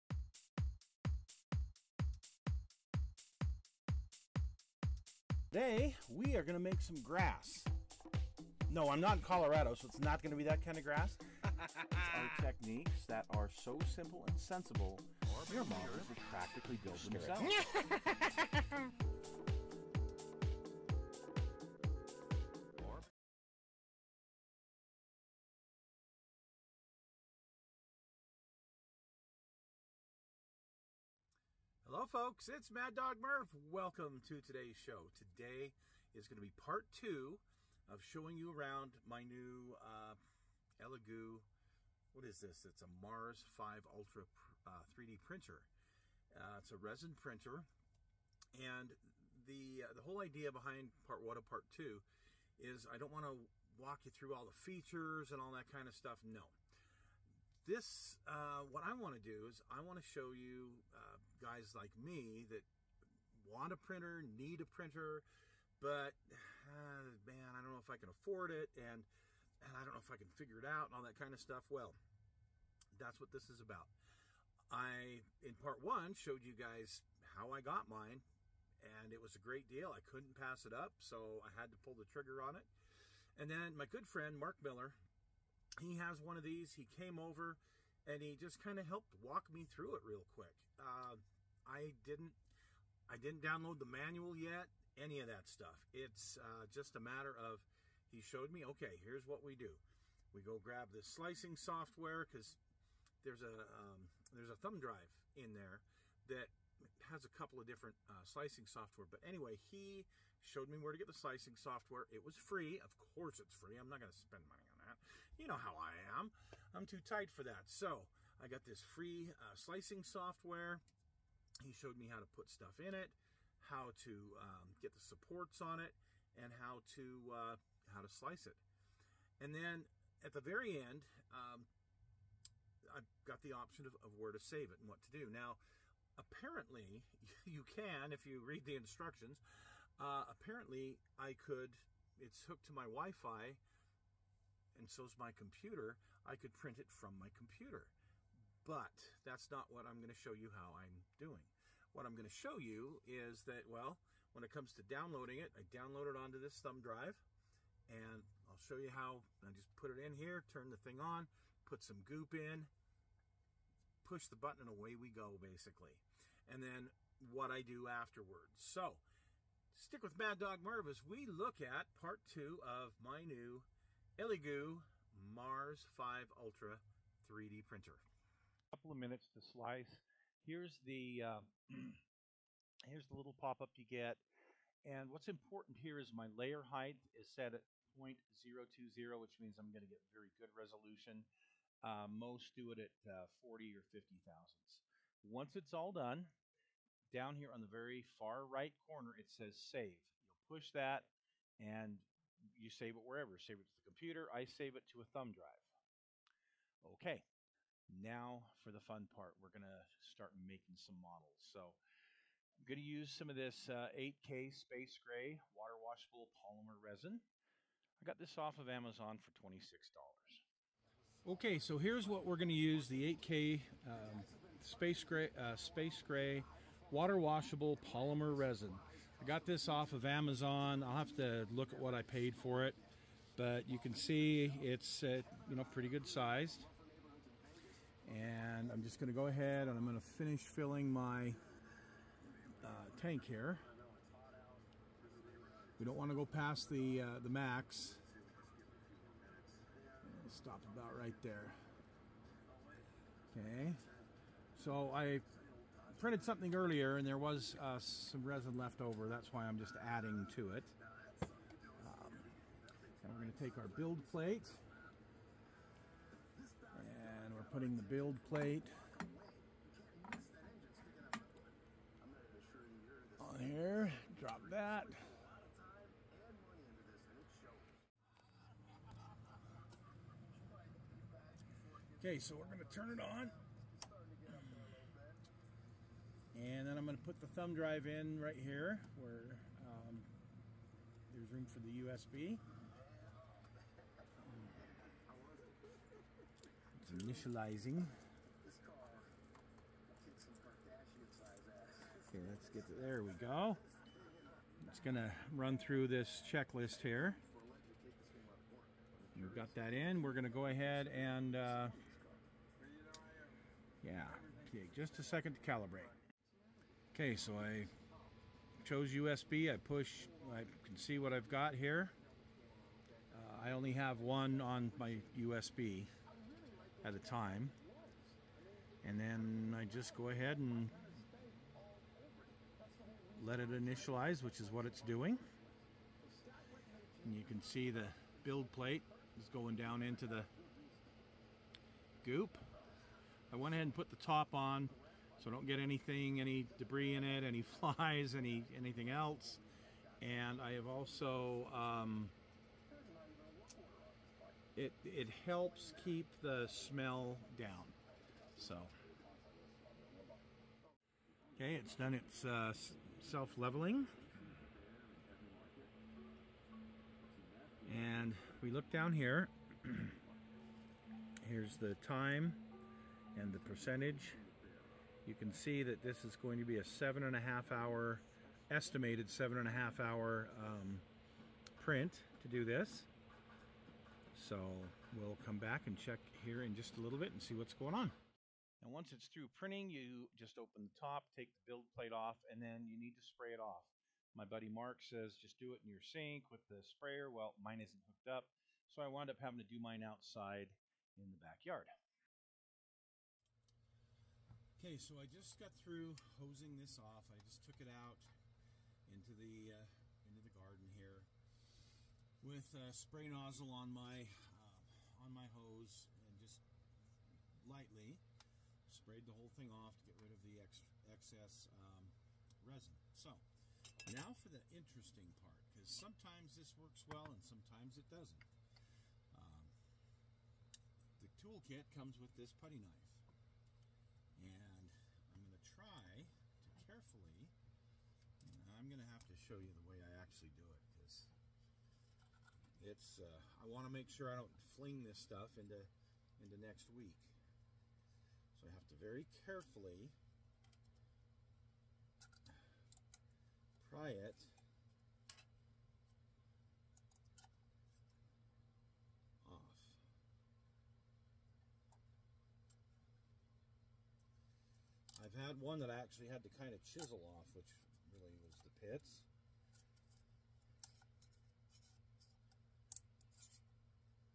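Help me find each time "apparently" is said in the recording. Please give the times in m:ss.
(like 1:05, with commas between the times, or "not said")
2:16, 2:20.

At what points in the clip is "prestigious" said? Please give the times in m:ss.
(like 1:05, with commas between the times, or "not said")
not said.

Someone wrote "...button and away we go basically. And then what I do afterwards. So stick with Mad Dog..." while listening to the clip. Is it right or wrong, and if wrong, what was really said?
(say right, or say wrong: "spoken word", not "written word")
right.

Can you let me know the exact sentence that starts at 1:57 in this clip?
So I got this free uh, slicing software.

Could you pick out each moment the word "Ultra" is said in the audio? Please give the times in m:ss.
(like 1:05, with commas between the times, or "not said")
0:43, 2:56.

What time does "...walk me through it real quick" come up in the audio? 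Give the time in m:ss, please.
1:29.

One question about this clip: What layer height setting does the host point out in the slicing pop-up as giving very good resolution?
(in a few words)
0.020.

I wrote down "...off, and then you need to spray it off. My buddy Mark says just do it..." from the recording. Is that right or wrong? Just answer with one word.
right.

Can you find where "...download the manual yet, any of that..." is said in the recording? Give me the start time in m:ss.
1:33.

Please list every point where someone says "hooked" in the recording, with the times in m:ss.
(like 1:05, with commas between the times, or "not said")
2:22, 6:37.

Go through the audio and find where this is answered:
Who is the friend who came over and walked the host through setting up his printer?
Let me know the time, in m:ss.
1:24.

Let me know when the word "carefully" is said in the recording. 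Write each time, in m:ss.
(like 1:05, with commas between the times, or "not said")
7:16, 7:29.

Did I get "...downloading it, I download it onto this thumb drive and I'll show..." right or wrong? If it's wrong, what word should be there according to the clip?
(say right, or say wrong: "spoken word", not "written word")
right.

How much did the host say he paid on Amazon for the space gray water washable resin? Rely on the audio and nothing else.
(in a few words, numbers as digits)
$26.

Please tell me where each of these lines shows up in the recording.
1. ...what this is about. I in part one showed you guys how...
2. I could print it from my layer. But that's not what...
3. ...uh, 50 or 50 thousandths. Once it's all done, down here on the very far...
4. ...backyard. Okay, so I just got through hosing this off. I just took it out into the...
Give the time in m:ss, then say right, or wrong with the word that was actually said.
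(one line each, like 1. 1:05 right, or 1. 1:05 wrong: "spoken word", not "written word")
1. 1:13 right
2. 2:26 wrong: "computer", not "layer"
3. 3:13 wrong: "40", not "50"
4. 6:41 right.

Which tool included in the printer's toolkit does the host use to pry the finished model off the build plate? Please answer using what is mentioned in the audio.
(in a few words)
putty knife.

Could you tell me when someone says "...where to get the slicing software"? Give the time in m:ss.
1:50.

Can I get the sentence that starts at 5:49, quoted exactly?
And I have also, um, it, it helps keep the smell down.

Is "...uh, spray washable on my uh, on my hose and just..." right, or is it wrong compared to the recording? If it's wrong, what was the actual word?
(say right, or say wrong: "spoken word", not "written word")
wrong: "nozzle", not "washable".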